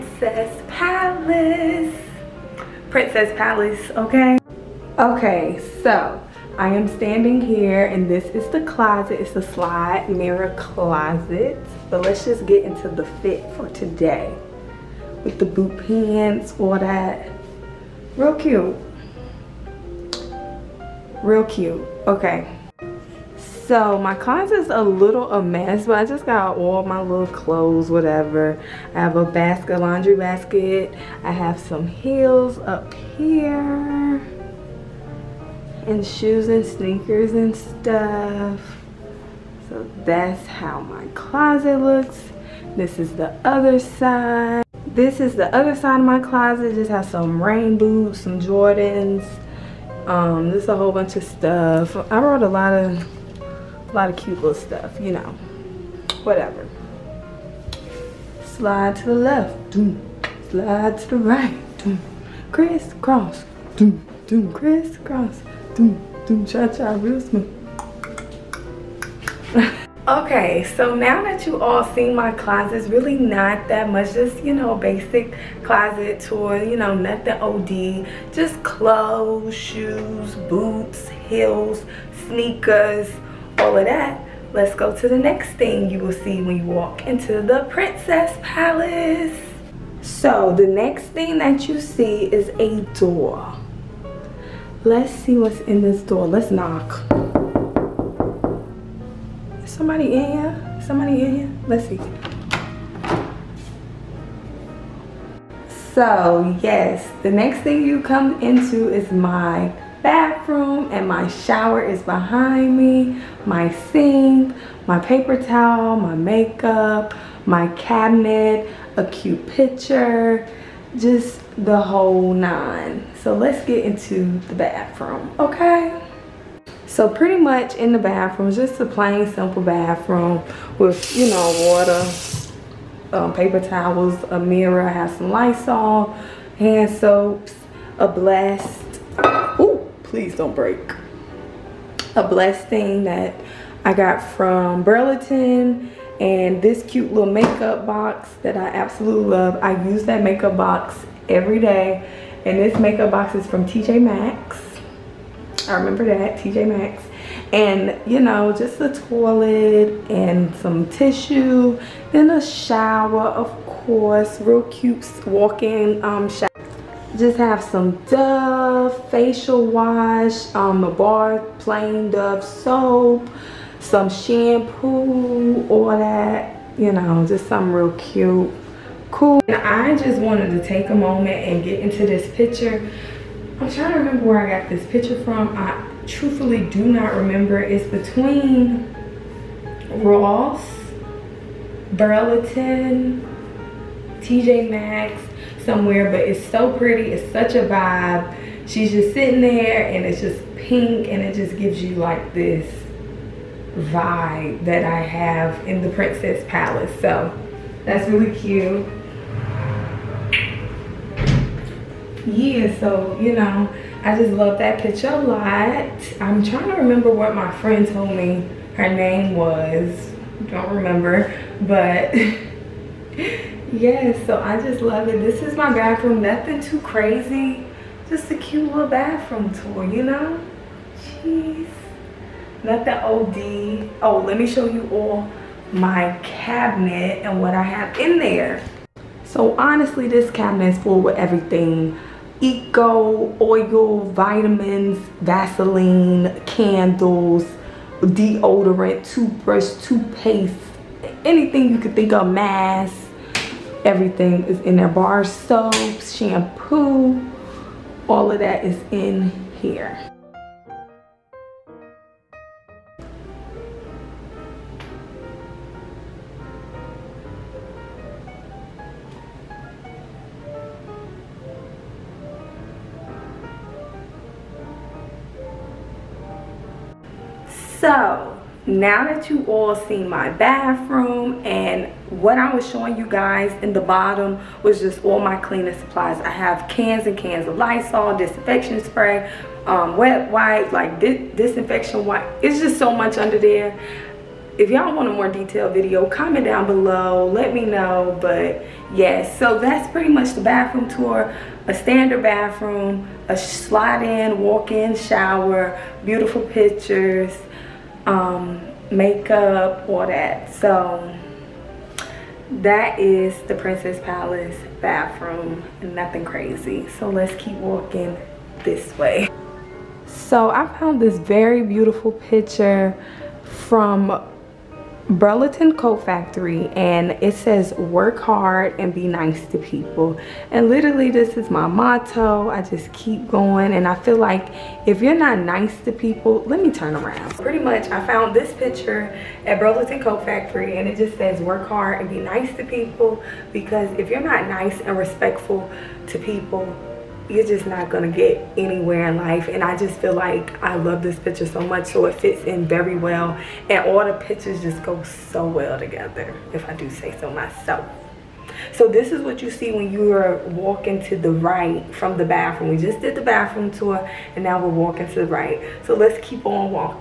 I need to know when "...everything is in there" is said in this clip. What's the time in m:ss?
4:13.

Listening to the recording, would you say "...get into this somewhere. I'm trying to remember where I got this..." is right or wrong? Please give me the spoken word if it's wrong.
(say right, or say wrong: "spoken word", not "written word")
wrong: "picture", not "somewhere".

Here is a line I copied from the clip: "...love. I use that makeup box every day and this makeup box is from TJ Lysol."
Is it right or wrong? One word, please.
wrong.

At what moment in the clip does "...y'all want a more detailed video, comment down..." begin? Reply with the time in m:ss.
4:54.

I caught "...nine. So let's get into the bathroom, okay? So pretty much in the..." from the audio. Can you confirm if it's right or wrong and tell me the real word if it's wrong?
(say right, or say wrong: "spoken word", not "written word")
right.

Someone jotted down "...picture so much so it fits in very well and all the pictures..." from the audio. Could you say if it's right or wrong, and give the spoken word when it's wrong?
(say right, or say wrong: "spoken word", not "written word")
right.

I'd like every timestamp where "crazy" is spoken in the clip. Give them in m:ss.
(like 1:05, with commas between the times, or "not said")
3:46, 5:16.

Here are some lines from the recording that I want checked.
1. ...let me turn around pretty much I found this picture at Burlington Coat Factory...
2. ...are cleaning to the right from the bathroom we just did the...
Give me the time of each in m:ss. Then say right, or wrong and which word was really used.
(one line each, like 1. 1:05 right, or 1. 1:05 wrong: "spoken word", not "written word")
1. 5:36 right
2. 6:00 wrong: "walking", not "cleaning".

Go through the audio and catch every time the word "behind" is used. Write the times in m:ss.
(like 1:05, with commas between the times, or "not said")
1:52.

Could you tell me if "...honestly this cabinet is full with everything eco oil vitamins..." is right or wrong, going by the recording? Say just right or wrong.
right.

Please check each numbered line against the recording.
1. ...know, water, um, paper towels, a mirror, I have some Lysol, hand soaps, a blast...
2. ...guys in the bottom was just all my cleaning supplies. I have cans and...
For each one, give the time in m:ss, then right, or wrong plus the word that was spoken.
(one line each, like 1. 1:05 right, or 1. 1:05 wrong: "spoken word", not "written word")
1. 2:11 right
2. 4:43 right.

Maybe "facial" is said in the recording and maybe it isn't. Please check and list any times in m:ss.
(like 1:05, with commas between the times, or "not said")
2:49.